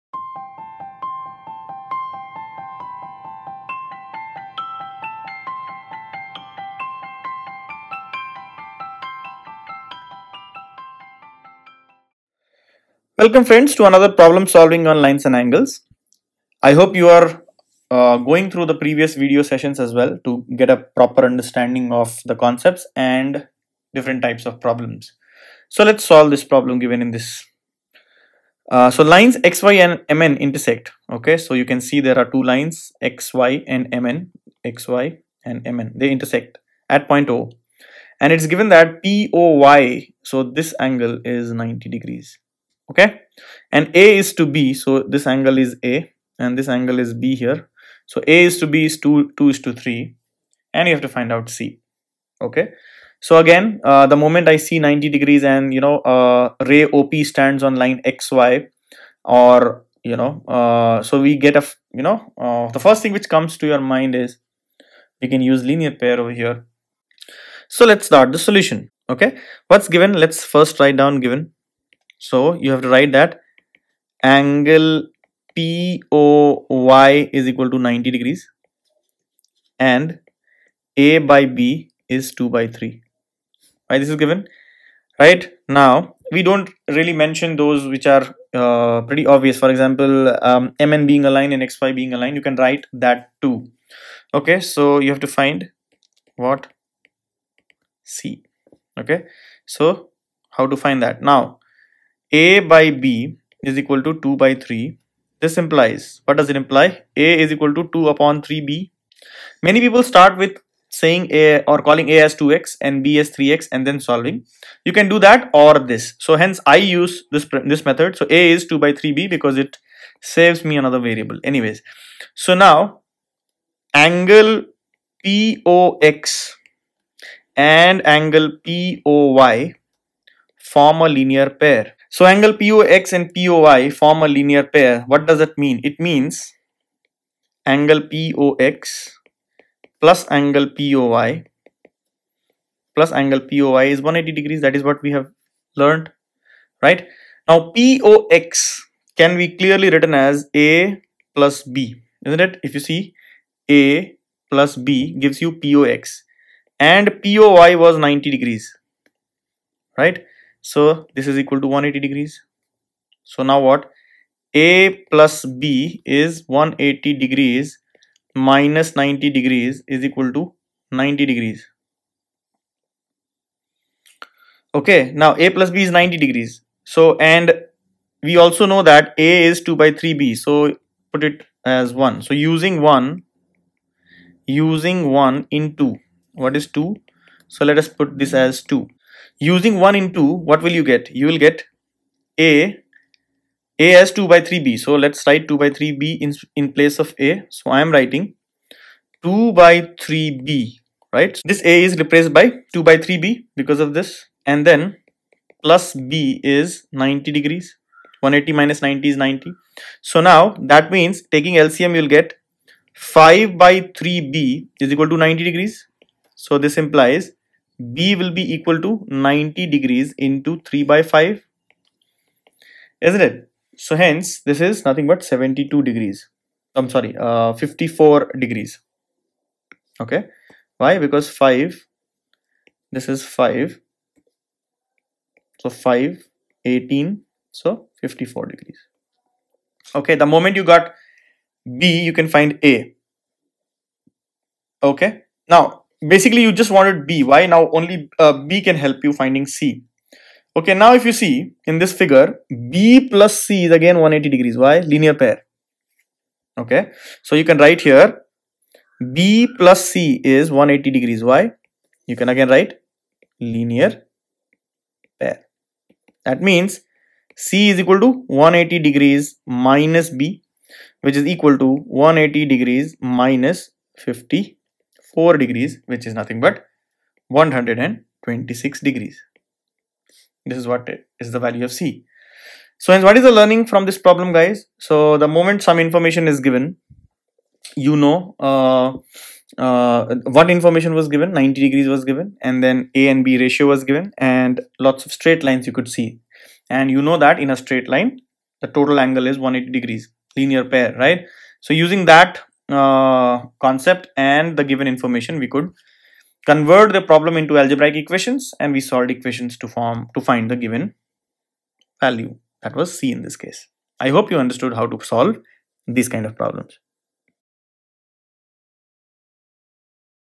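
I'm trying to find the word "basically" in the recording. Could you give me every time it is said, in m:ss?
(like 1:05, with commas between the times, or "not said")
4:06.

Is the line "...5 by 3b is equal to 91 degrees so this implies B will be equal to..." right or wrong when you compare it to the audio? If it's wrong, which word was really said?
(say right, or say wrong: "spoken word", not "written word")
wrong: "90", not "91".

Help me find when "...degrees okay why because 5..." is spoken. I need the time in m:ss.
3:48.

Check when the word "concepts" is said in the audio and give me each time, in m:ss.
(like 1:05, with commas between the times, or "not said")
0:22, 5:03.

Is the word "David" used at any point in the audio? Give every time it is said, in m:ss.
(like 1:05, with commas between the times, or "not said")
not said.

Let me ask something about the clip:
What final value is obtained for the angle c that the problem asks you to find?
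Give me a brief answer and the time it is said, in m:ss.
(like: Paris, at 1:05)
126 degrees, at 4:37.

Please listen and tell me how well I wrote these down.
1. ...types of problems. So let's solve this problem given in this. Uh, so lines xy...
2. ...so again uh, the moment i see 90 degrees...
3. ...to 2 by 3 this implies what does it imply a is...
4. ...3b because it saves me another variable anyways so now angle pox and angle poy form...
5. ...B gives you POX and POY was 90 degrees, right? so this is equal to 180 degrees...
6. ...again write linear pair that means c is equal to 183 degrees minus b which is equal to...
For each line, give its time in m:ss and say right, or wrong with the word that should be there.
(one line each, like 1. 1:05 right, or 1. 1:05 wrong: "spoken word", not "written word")
1. 0:24 right
2. 0:53 right
3. 1:44 right
4. 1:58 right
5. 2:34 right
6. 4:22 wrong: "180", not "183".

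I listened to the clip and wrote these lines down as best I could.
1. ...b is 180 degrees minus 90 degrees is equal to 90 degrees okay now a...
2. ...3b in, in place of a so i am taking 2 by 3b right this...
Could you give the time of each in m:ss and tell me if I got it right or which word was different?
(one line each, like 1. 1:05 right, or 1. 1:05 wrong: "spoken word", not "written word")
1. 2:45 right
2. 3:15 wrong: "writing", not "taking".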